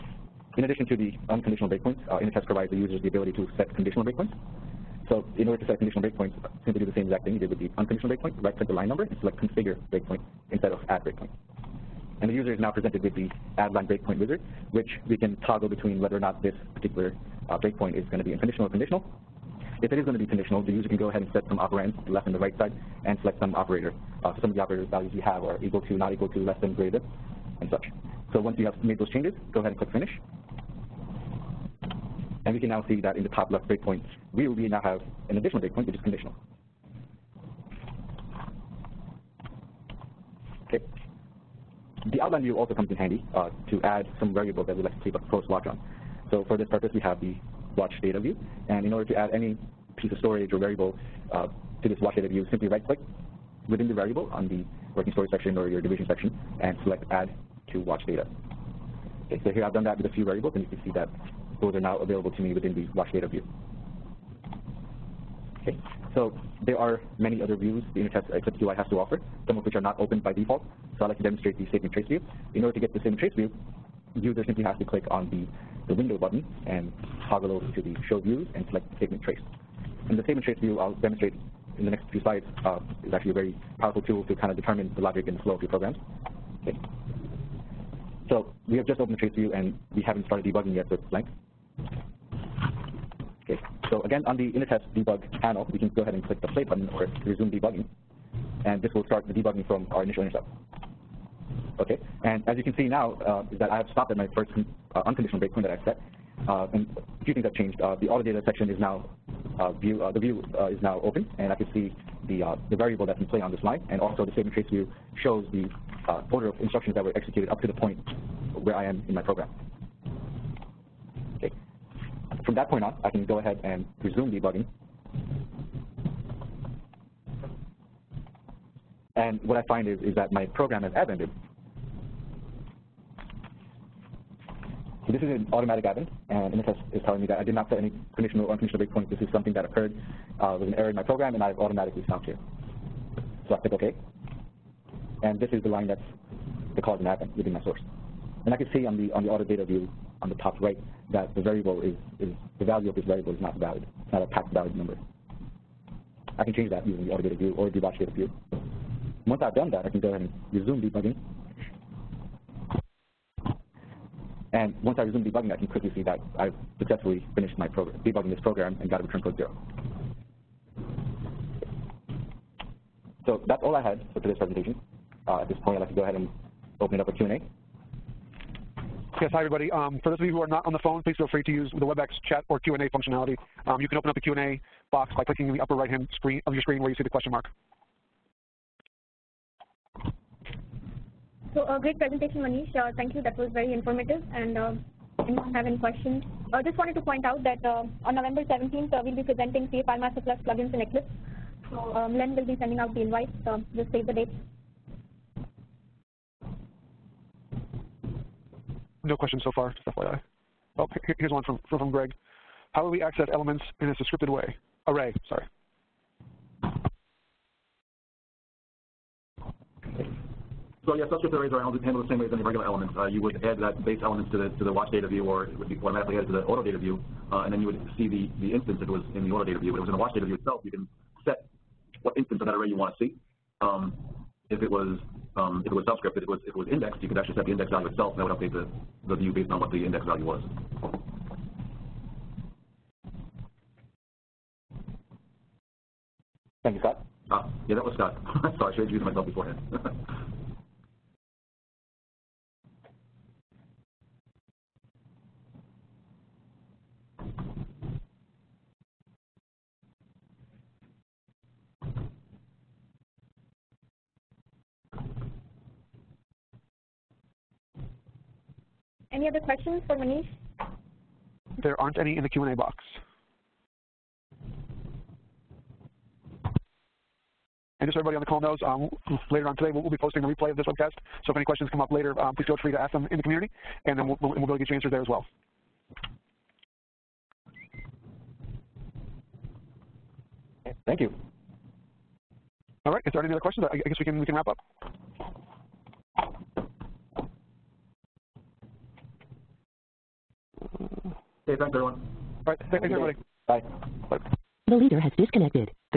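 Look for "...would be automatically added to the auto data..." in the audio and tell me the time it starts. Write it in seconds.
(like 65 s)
225 s.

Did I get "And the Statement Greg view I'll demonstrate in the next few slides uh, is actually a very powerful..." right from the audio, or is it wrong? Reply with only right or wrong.
wrong.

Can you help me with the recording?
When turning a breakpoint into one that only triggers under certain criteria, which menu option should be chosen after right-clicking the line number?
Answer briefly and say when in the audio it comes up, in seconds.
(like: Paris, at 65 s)
Configure breakpoint, at 9 s.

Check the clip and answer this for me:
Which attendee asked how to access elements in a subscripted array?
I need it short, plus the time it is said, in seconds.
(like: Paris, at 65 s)
Greg, at 211 s.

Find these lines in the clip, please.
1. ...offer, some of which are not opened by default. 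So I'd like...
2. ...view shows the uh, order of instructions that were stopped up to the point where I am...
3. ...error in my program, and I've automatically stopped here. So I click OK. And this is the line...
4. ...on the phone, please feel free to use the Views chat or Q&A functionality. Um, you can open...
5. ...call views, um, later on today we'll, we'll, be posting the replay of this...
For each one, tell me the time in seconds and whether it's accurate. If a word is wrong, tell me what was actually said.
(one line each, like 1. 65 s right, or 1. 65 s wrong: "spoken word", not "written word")
1. 68 s right
2. 114 s wrong: "executed", not "stopped"
3. 140 s right
4. 180 s wrong: "WebEx", not "Views"
5. 278 s wrong: "knows", not "views".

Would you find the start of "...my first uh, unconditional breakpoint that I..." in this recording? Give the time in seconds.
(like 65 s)
104 s.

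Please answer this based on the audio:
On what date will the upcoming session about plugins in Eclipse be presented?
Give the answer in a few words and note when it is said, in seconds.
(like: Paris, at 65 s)
November 17th, at 198 s.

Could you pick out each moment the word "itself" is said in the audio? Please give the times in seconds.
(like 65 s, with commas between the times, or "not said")
230 s, 237 s.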